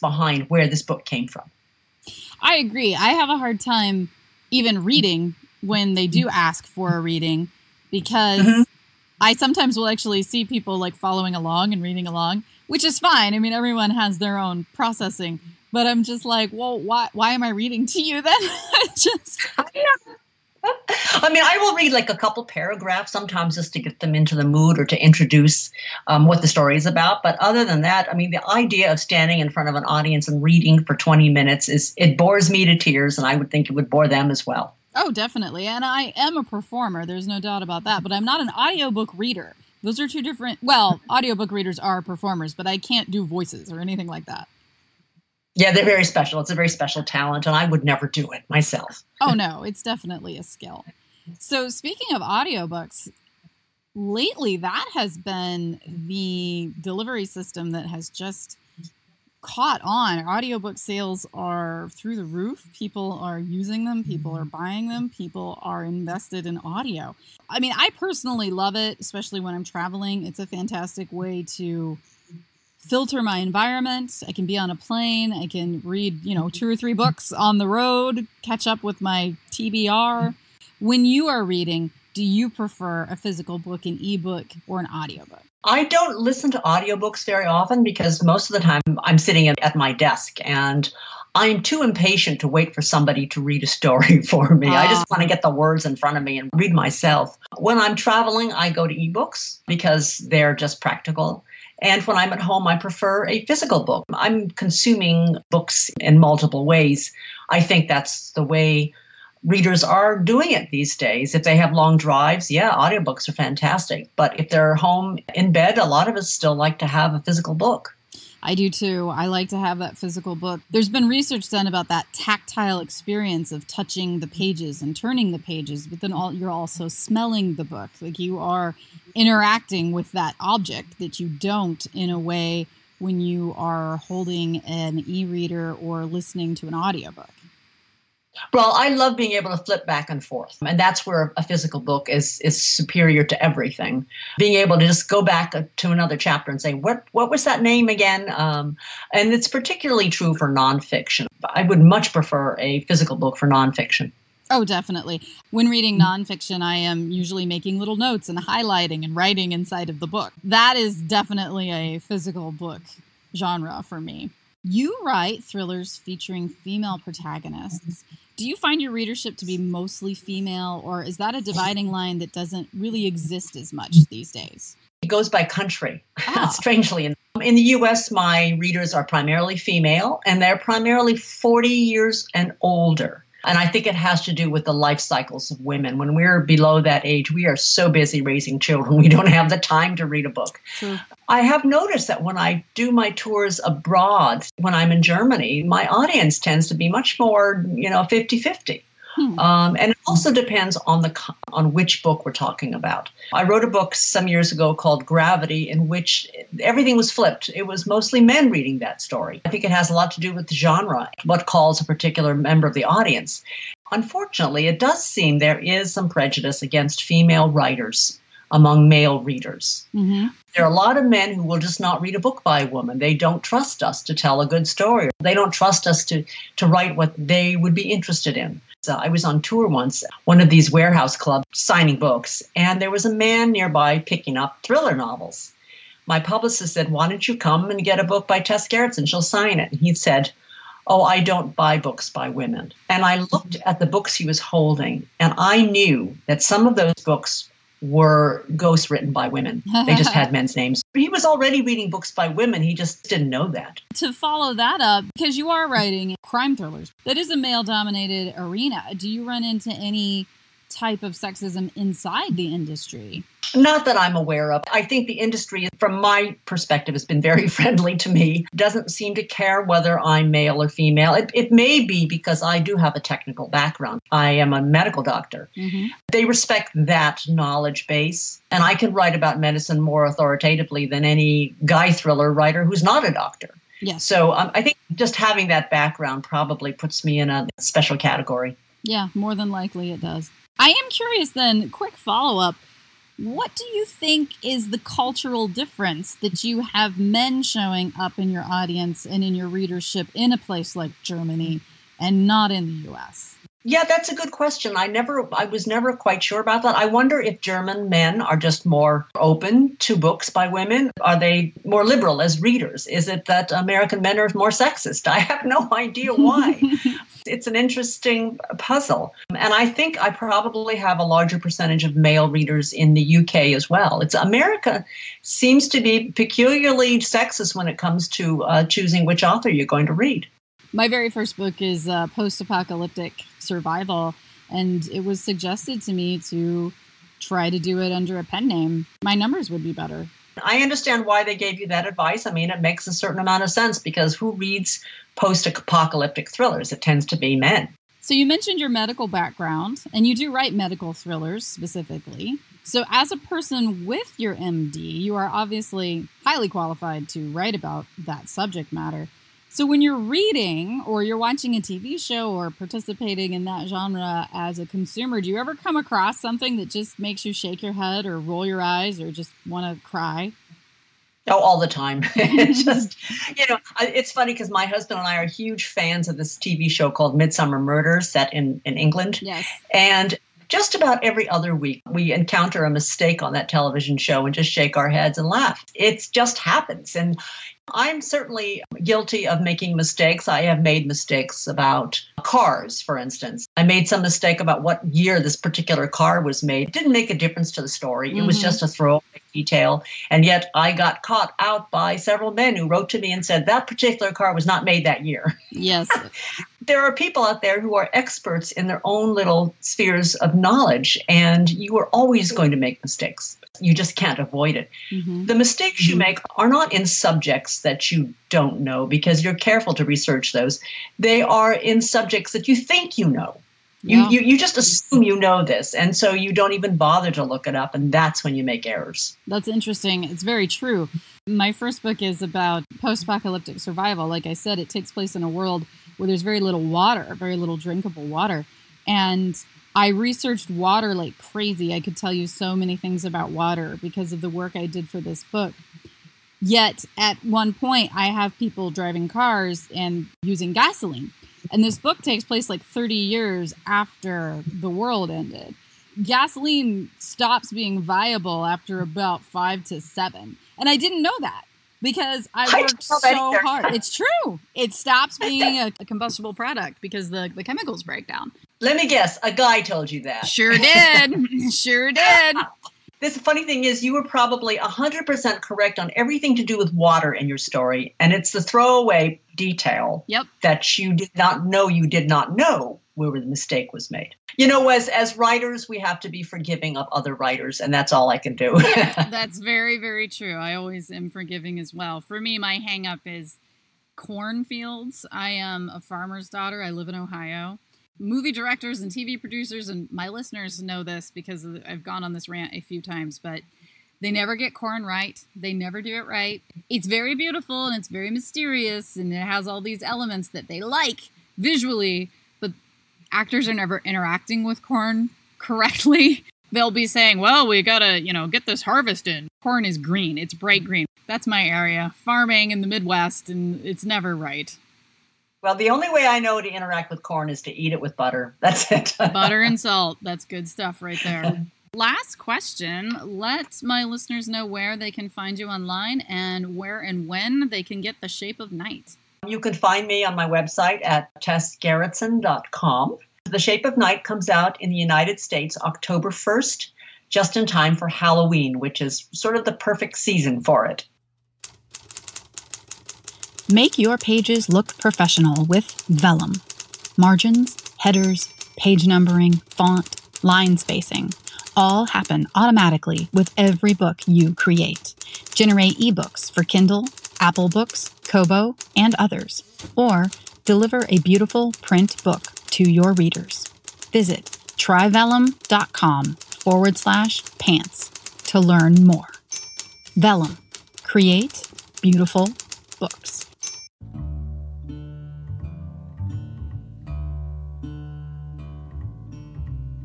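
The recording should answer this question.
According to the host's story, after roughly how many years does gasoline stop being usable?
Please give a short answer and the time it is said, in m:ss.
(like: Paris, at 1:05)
five to seven, at 7:39.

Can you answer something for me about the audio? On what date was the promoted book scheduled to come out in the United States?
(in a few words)
October 1.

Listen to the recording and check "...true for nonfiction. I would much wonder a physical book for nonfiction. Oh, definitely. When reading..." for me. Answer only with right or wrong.
wrong.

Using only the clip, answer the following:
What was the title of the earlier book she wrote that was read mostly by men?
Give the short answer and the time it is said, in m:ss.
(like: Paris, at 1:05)
Gravity, at 3:25.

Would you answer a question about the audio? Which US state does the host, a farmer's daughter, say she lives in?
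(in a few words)
Ohio.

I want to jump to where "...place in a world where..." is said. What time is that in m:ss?
7:14.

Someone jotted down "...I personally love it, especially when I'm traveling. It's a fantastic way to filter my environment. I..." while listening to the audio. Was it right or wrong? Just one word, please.
right.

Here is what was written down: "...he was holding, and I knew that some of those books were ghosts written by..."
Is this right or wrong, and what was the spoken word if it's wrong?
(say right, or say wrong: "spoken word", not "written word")
right.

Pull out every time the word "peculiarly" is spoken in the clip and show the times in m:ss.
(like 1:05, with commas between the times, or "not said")
5:26.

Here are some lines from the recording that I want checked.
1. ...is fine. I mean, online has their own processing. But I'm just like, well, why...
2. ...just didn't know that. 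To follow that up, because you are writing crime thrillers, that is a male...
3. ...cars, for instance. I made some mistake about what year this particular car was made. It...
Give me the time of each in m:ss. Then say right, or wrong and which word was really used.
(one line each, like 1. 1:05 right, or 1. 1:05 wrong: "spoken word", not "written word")
1. 0:12 wrong: "everyone", not "online"
2. 4:12 right
3. 6:32 right.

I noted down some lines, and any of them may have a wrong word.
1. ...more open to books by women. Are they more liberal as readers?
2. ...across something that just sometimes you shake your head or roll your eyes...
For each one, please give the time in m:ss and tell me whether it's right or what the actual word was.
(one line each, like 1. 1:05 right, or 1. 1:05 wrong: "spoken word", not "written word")
1. 5:08 right
2. 6:05 wrong: "makes", not "sometimes".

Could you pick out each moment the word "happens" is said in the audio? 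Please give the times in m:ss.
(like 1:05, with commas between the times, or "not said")
6:26, 9:21.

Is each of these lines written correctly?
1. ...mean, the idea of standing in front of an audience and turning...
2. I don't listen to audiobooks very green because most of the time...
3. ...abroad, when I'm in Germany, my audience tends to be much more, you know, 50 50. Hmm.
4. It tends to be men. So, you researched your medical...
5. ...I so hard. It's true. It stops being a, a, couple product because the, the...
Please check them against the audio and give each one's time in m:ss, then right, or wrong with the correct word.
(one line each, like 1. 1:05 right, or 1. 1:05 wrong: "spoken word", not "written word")
1. 0:28 wrong: "reading", not "turning"
2. 1:25 wrong: "often", not "green"
3. 3:13 right
4. 5:46 wrong: "mentioned", not "researched"
5. 7:42 wrong: "combustible", not "couple".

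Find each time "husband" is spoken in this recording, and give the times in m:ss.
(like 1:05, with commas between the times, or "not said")
6:14.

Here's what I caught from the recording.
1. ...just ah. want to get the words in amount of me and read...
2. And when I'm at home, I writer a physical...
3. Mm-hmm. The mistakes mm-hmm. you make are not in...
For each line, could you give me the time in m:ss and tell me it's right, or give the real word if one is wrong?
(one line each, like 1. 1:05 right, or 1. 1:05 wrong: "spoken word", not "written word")
1. 1:34 wrong: "front", not "amount"
2. 1:41 wrong: "prefer", not "writer"
3. 6:54 right.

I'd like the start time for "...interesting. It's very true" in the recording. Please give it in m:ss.
7:09.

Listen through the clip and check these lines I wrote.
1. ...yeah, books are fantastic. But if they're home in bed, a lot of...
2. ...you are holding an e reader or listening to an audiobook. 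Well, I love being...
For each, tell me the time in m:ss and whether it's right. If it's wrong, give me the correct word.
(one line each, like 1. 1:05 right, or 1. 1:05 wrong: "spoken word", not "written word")
1. 1:52 wrong: "audiobooks", not "books"
2. 2:13 right.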